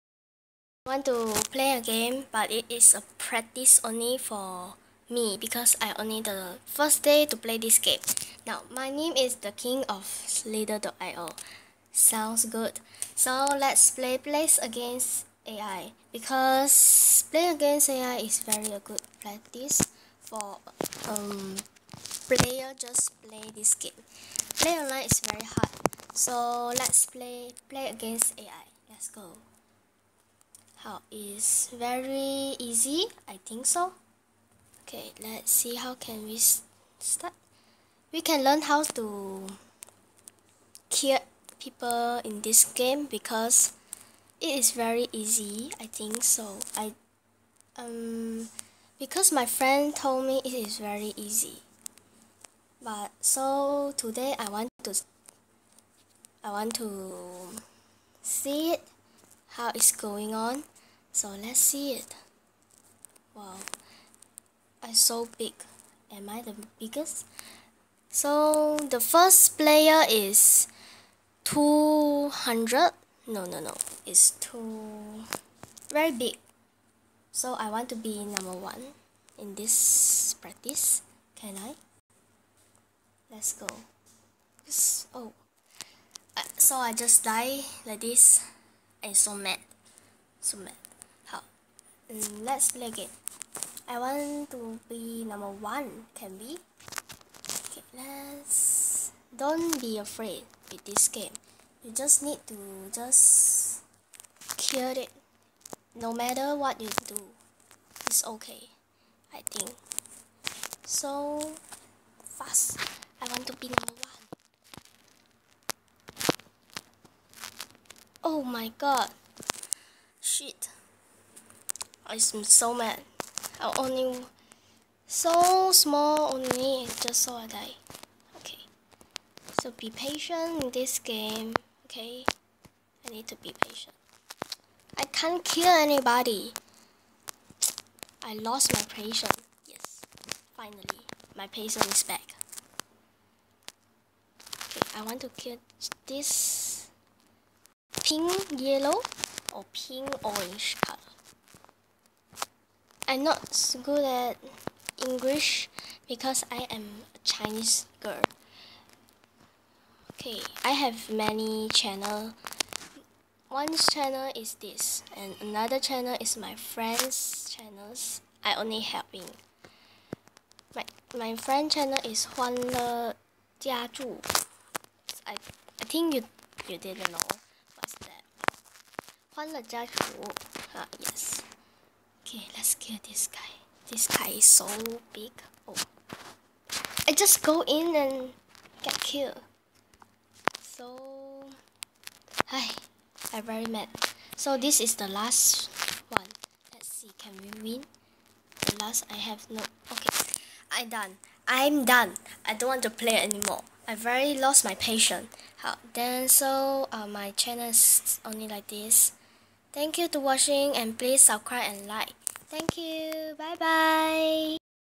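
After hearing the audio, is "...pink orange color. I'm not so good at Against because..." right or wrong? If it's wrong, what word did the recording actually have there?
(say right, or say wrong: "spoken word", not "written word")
wrong: "English", not "Against".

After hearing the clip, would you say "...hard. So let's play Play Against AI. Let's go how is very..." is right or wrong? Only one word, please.
right.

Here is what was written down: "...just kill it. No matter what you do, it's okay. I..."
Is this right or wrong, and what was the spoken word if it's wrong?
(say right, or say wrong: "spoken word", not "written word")
right.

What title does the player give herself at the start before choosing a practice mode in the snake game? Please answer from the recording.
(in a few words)
The king of Slither.io.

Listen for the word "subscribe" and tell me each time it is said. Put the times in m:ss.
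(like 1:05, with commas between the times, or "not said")
3:31.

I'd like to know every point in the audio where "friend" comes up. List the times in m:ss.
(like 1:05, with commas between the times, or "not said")
0:49, 2:46, 2:51.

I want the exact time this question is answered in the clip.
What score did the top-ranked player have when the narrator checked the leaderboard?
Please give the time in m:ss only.
1:11.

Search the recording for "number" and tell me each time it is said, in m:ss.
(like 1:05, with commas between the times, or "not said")
1:18, 1:35, 1:53.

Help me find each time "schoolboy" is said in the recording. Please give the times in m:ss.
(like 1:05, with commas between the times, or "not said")
not said.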